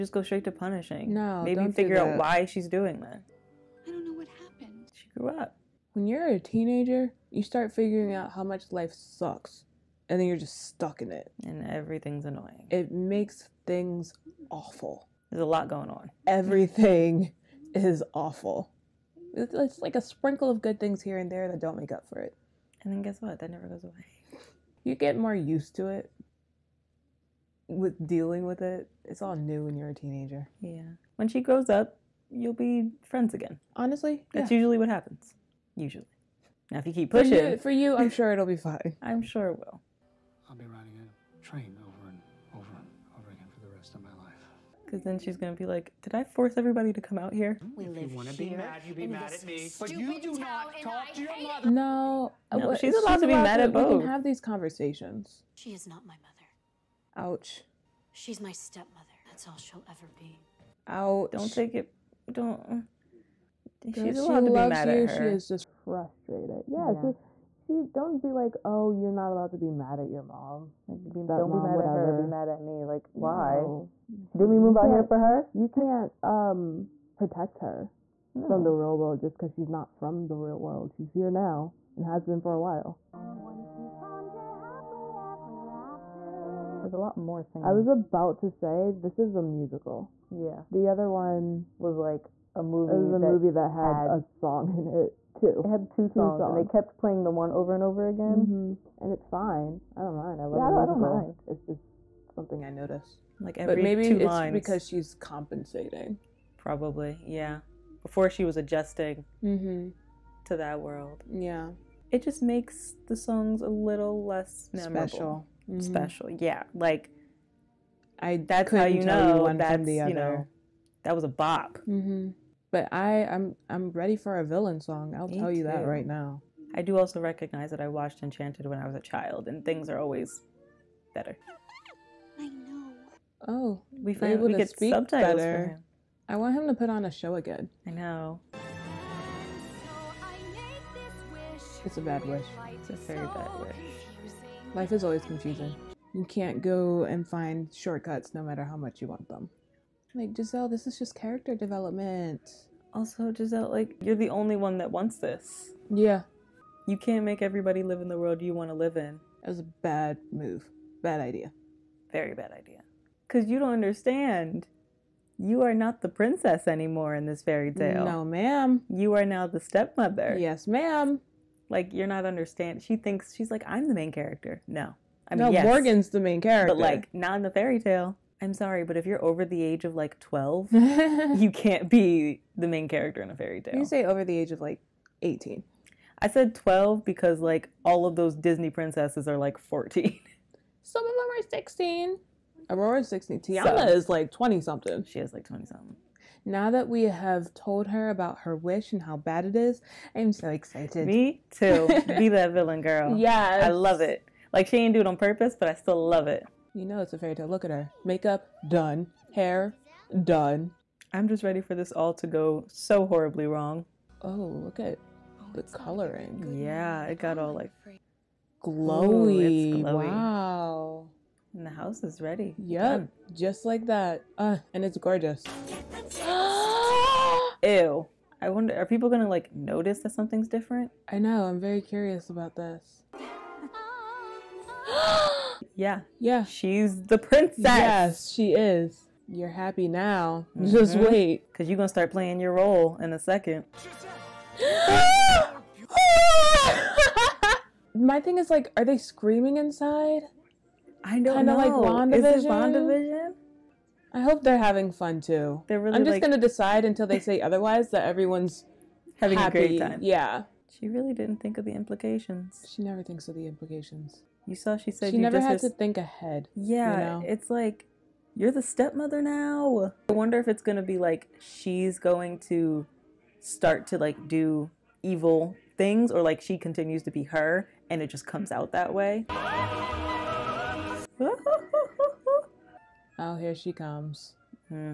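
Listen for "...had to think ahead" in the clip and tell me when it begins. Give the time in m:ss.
4:25.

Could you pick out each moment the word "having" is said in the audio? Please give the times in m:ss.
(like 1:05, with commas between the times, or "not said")
4:14, 4:19.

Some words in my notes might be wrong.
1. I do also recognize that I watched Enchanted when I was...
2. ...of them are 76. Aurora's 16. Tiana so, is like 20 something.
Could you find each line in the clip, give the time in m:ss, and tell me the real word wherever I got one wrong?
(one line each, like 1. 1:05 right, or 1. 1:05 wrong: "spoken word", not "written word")
1. 2:06 right
2. 3:11 wrong: "16", not "76".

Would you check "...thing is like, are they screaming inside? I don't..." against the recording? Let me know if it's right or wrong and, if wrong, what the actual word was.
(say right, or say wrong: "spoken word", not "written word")
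right.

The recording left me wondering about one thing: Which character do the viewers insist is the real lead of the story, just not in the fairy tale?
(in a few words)
Morgan.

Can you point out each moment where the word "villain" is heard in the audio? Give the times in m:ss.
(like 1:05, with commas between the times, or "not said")
2:04, 3:22.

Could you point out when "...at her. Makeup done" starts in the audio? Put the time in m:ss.
3:27.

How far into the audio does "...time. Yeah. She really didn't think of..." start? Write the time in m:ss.
4:19.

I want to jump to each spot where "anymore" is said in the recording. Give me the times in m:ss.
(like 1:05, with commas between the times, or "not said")
2:46.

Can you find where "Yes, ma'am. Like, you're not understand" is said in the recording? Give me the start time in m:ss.
2:50.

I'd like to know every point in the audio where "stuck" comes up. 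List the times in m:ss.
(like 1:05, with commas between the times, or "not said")
0:10.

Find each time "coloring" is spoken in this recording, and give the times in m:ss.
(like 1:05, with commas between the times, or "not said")
3:35.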